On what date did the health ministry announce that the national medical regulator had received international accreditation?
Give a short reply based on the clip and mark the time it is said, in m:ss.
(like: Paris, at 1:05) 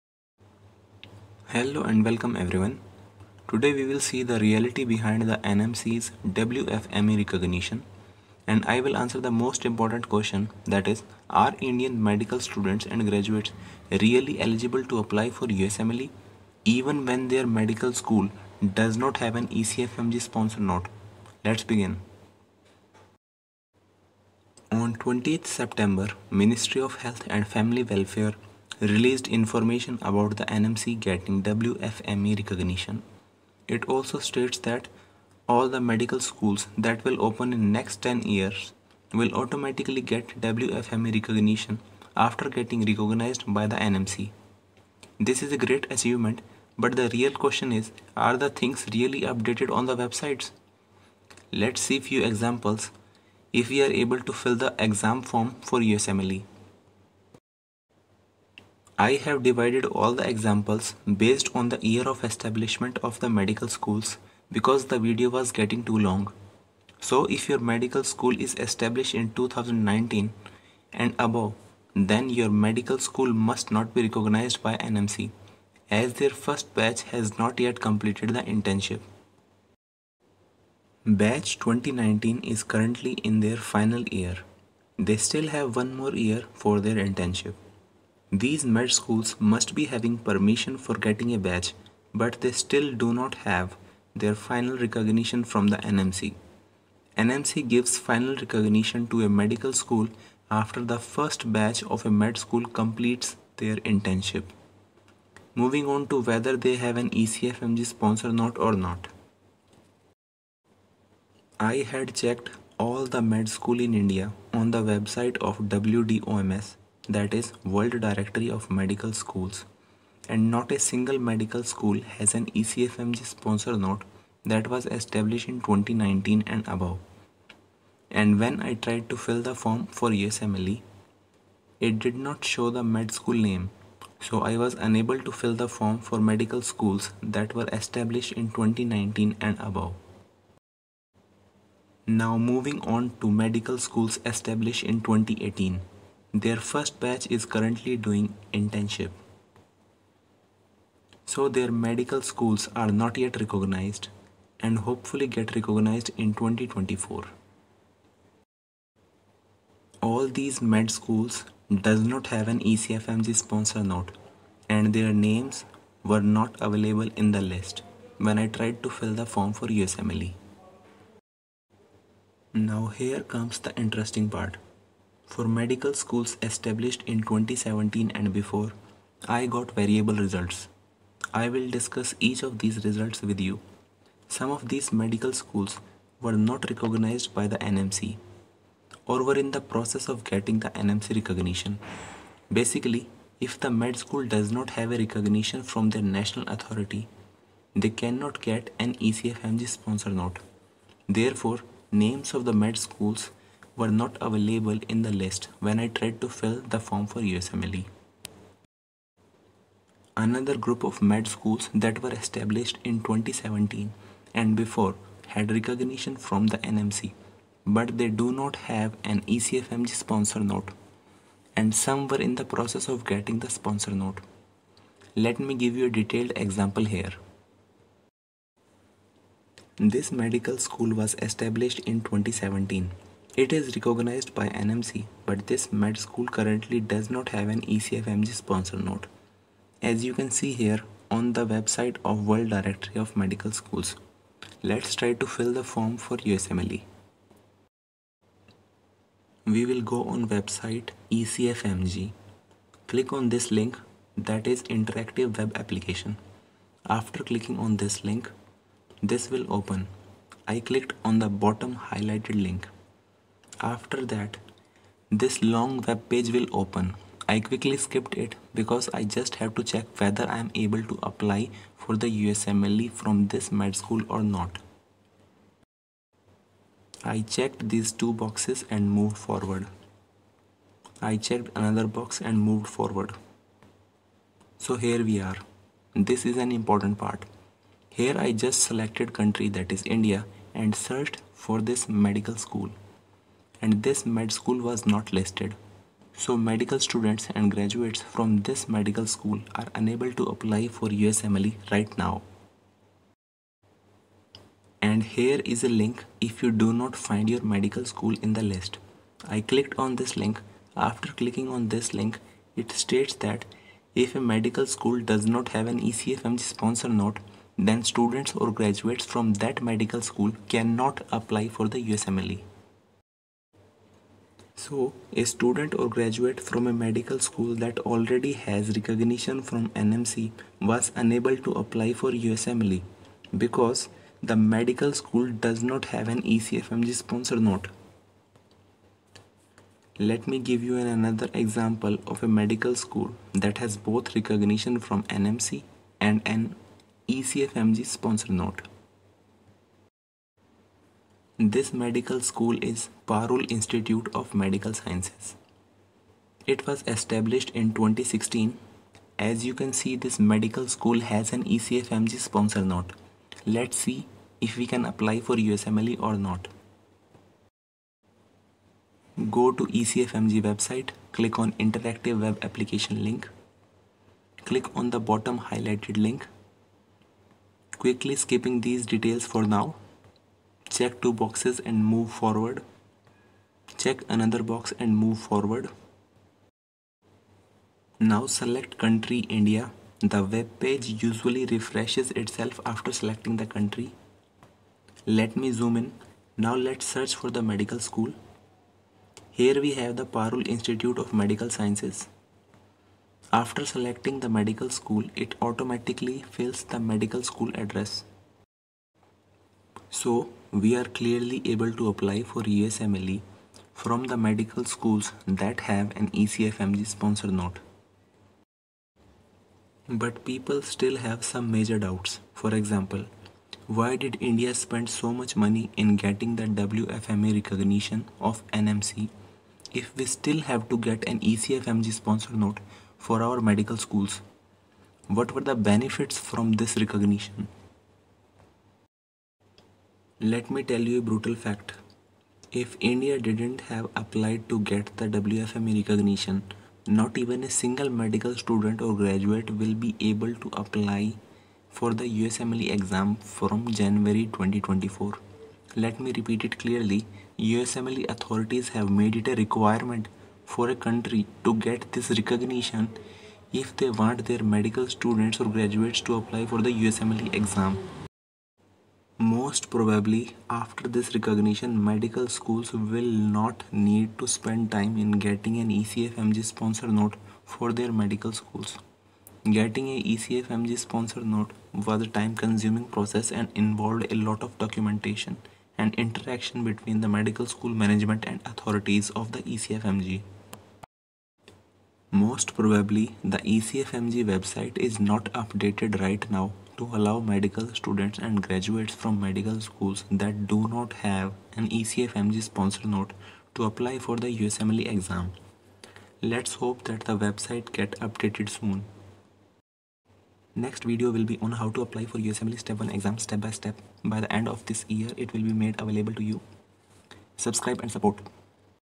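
20th September, at 0:24.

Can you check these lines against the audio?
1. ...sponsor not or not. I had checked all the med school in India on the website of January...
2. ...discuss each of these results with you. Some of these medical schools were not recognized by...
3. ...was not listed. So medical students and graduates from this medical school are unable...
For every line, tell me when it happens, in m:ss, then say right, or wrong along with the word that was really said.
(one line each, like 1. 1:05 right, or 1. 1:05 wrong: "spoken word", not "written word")
1. 1:47 wrong: "WDOMS", not "January"
2. 3:01 right
3. 4:54 right.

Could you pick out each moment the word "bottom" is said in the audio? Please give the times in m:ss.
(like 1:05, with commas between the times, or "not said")
4:21, 6:14.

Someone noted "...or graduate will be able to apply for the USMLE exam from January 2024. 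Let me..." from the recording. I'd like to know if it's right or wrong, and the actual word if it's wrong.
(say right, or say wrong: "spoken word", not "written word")
right.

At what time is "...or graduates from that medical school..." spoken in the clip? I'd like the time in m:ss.
5:18.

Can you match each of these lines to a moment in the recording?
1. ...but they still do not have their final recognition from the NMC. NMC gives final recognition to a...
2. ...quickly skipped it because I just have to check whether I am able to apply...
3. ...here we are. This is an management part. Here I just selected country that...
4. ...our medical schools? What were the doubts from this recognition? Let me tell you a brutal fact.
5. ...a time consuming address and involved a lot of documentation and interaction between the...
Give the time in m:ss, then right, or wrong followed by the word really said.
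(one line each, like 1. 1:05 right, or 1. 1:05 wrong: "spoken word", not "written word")
1. 1:32 right
2. 4:27 right
3. 4:44 wrong: "important", not "management"
4. 7:13 wrong: "benefits", not "doubts"
5. 8:02 wrong: "process", not "address".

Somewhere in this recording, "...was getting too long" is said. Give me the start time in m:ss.
1:05.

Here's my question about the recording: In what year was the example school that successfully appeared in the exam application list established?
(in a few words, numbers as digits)
2016.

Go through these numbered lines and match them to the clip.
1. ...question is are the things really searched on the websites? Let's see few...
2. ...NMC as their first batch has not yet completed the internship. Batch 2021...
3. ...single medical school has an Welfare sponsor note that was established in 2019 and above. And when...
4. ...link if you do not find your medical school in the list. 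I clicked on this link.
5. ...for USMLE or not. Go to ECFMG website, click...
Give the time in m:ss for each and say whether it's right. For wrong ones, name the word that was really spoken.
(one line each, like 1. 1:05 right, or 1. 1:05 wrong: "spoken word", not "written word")
1. 0:47 wrong: "updated", not "searched"
2. 1:14 wrong: "2019", not "2021"
3. 2:00 wrong: "ECFMG", not "Welfare"
4. 5:05 right
5. 6:05 right.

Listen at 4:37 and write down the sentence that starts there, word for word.
I checked these two boxes and moved forward.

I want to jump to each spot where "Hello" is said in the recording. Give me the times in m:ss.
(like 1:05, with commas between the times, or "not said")
0:01.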